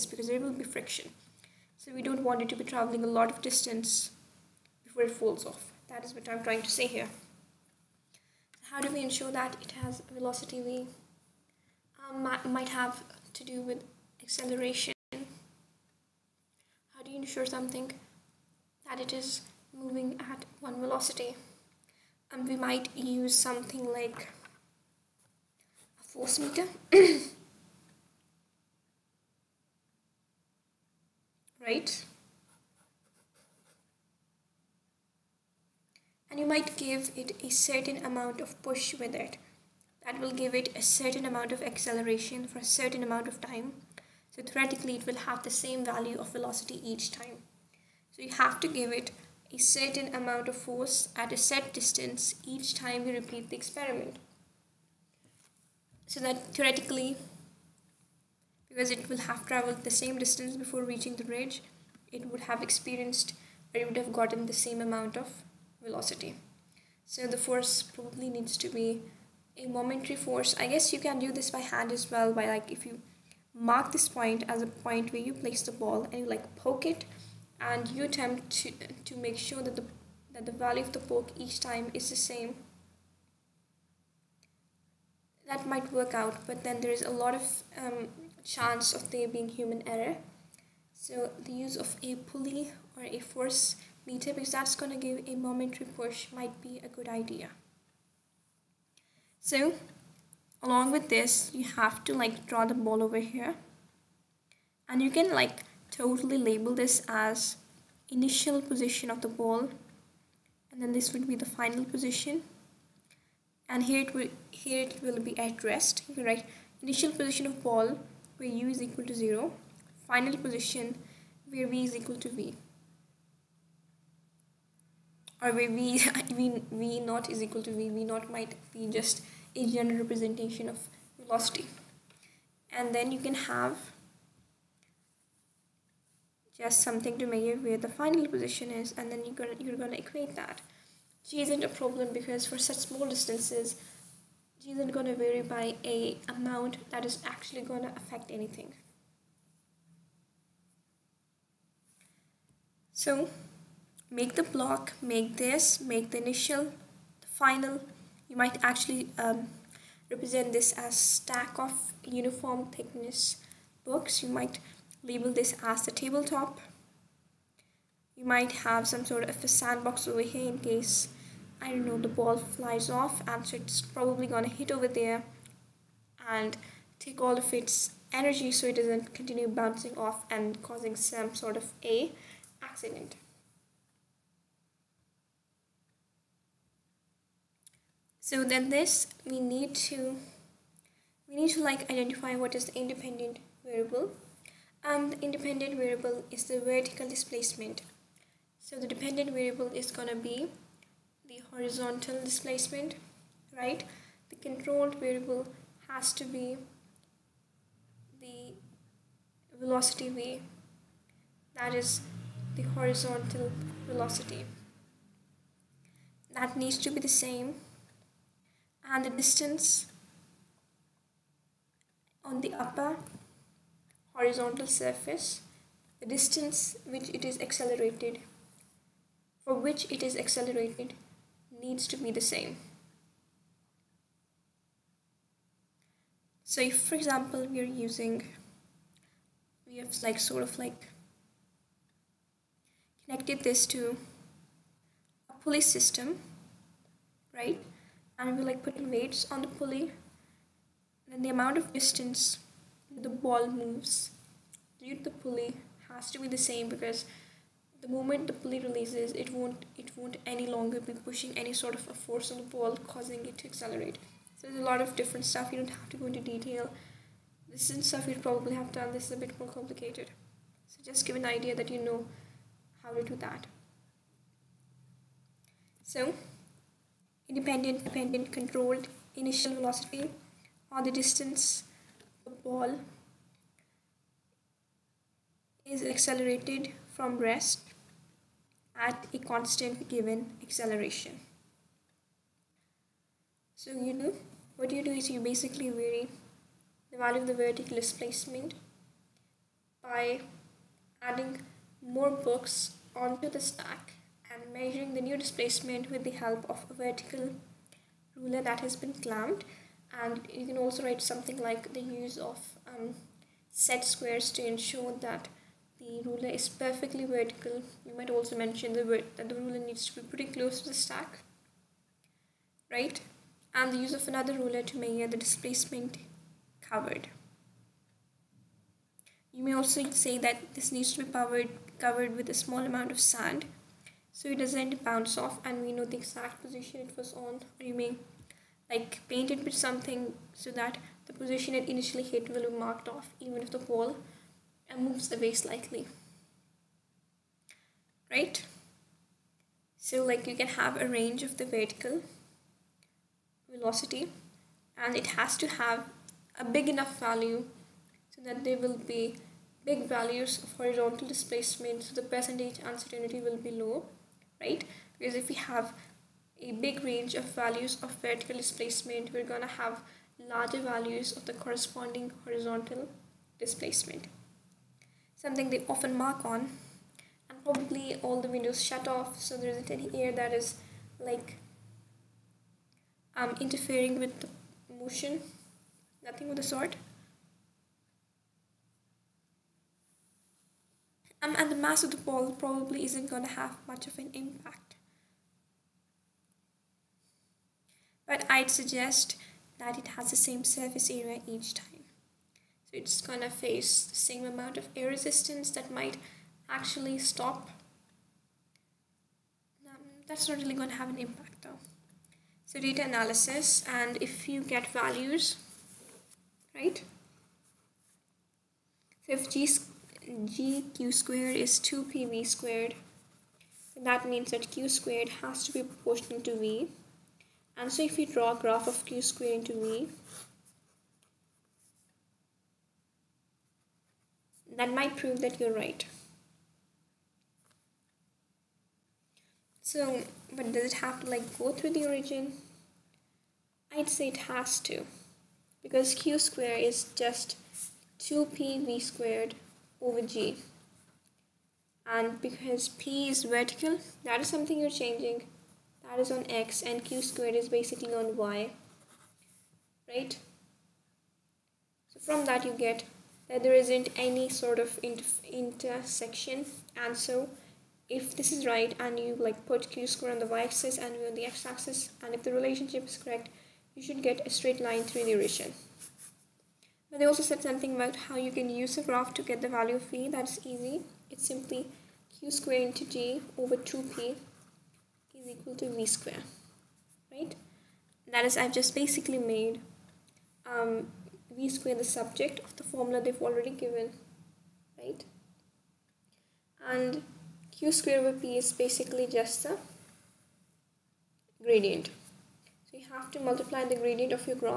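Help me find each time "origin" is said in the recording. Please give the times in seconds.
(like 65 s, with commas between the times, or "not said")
441 s, 475 s.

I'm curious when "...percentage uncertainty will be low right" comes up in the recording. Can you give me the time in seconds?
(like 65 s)
362 s.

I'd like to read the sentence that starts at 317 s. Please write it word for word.
You might also mention the that the ruler needs to be pretty close to the stack, right?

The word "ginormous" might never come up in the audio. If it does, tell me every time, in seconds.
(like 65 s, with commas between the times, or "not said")
not said.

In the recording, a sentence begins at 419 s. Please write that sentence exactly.
So if g gq squared is 2pv squared.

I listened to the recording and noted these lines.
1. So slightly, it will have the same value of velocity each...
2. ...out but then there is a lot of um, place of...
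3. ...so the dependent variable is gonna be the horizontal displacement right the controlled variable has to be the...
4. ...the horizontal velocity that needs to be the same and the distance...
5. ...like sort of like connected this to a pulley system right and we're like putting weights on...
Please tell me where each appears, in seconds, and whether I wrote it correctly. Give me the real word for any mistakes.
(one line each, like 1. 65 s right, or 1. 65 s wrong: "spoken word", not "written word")
1. 44 s wrong: "theoretically", not "slightly"
2. 86 s wrong: "chance", not "place"
3. 198 s right
4. 212 s right
5. 240 s right.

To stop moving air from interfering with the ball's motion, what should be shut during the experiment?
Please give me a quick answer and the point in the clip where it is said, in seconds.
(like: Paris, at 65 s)
All the windows, at 378 s.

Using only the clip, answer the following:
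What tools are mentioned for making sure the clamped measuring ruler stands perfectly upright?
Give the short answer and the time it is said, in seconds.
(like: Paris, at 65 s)
Set squares, at 313 s.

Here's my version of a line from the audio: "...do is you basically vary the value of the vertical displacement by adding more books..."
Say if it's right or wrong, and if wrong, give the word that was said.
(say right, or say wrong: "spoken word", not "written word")
right.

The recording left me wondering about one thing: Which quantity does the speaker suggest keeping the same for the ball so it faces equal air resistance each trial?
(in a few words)
Surface area.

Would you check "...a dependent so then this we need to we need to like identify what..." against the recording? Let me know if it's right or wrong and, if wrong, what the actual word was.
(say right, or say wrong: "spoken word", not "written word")
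wrong: "accident", not "dependent".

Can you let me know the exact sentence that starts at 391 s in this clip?
Um, and the mass of the ball probably isn't going to have much of an impact.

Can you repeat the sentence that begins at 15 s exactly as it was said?
How do you ensure something that it is moving at one velocity?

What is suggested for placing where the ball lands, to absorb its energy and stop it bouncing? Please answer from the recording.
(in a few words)
A sandbox.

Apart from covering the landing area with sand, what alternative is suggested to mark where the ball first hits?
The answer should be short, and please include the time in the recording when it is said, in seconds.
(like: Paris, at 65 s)
Paint, at 339 s.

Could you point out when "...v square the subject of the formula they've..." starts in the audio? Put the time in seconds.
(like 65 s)
491 s.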